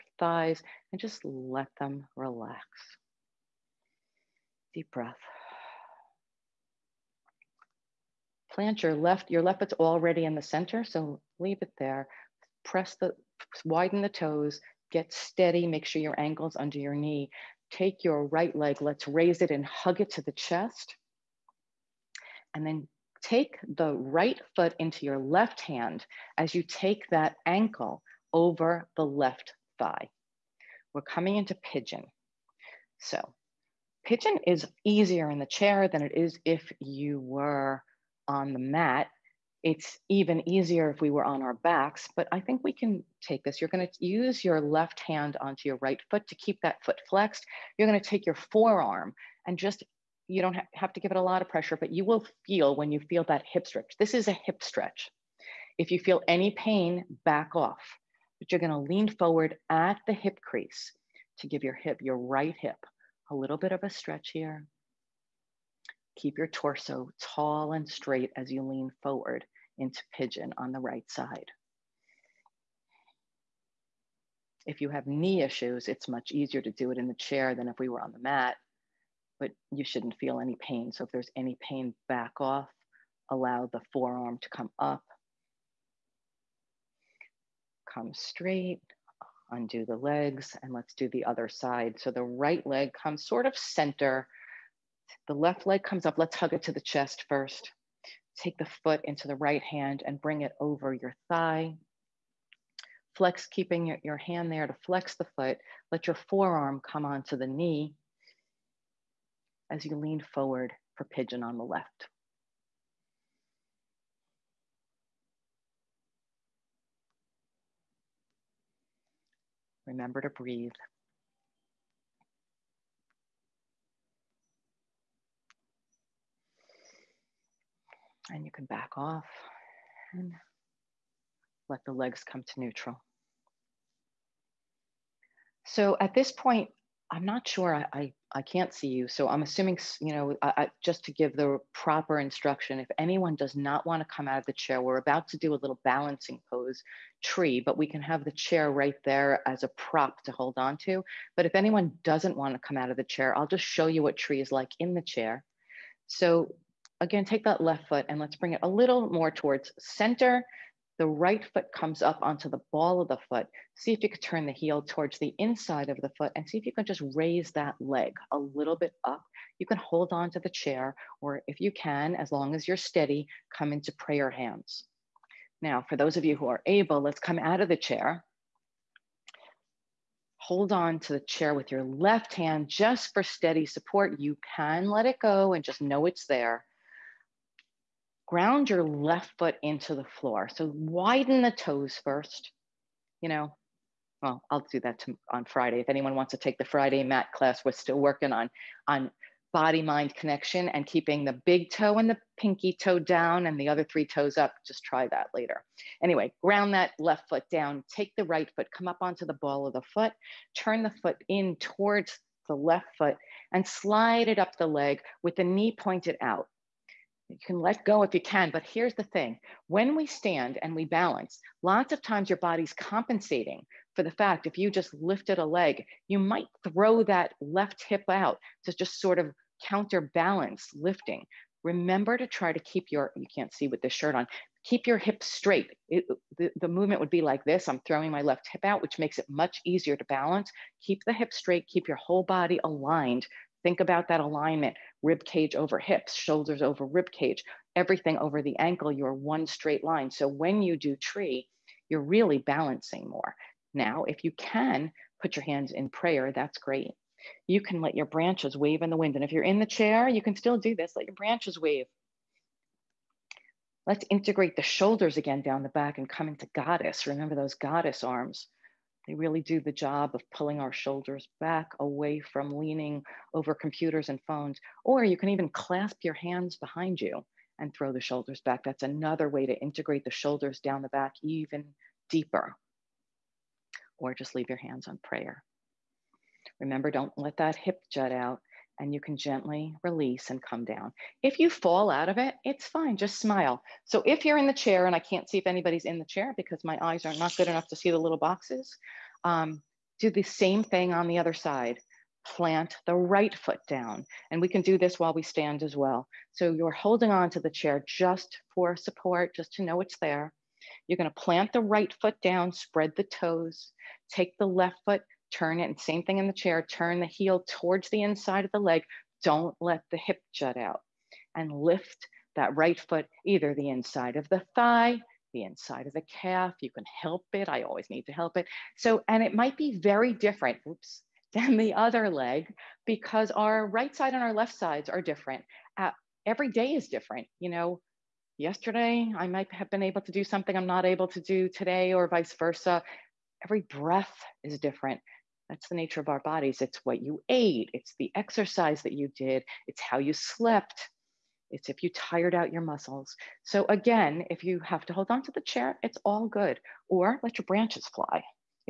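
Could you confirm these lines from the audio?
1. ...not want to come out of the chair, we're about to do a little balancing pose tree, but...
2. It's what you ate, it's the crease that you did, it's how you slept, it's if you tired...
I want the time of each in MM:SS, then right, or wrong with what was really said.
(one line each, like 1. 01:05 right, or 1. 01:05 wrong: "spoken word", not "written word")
1. 02:23 right
2. 05:46 wrong: "exercise", not "crease".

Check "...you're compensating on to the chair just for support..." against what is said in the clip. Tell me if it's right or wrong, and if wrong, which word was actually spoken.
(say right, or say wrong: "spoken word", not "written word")
wrong: "holding", not "compensating".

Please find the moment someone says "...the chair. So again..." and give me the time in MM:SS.
02:34.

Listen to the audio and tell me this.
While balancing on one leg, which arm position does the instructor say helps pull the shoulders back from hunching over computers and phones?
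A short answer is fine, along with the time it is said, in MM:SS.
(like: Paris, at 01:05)
Goddess arms, at 04:27.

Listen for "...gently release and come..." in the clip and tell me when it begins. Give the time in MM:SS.
04:49.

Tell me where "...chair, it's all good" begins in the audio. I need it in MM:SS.
05:55.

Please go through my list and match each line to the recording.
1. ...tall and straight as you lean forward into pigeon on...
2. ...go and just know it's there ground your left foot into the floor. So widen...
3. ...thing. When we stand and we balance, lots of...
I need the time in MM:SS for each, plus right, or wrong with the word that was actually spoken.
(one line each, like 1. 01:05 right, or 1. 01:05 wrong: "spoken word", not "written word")
1. 01:07 right
2. 03:05 right
3. 03:39 right.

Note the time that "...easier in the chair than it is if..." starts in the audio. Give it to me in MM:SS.
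00:34.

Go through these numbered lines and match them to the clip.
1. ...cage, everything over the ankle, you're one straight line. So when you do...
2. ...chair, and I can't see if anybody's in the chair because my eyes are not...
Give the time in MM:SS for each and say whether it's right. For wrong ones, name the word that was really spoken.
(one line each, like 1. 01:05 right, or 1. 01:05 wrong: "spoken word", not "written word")
1. 04:07 right
2. 04:54 right.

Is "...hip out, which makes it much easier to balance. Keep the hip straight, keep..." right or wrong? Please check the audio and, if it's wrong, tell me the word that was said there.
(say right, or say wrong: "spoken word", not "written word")
right.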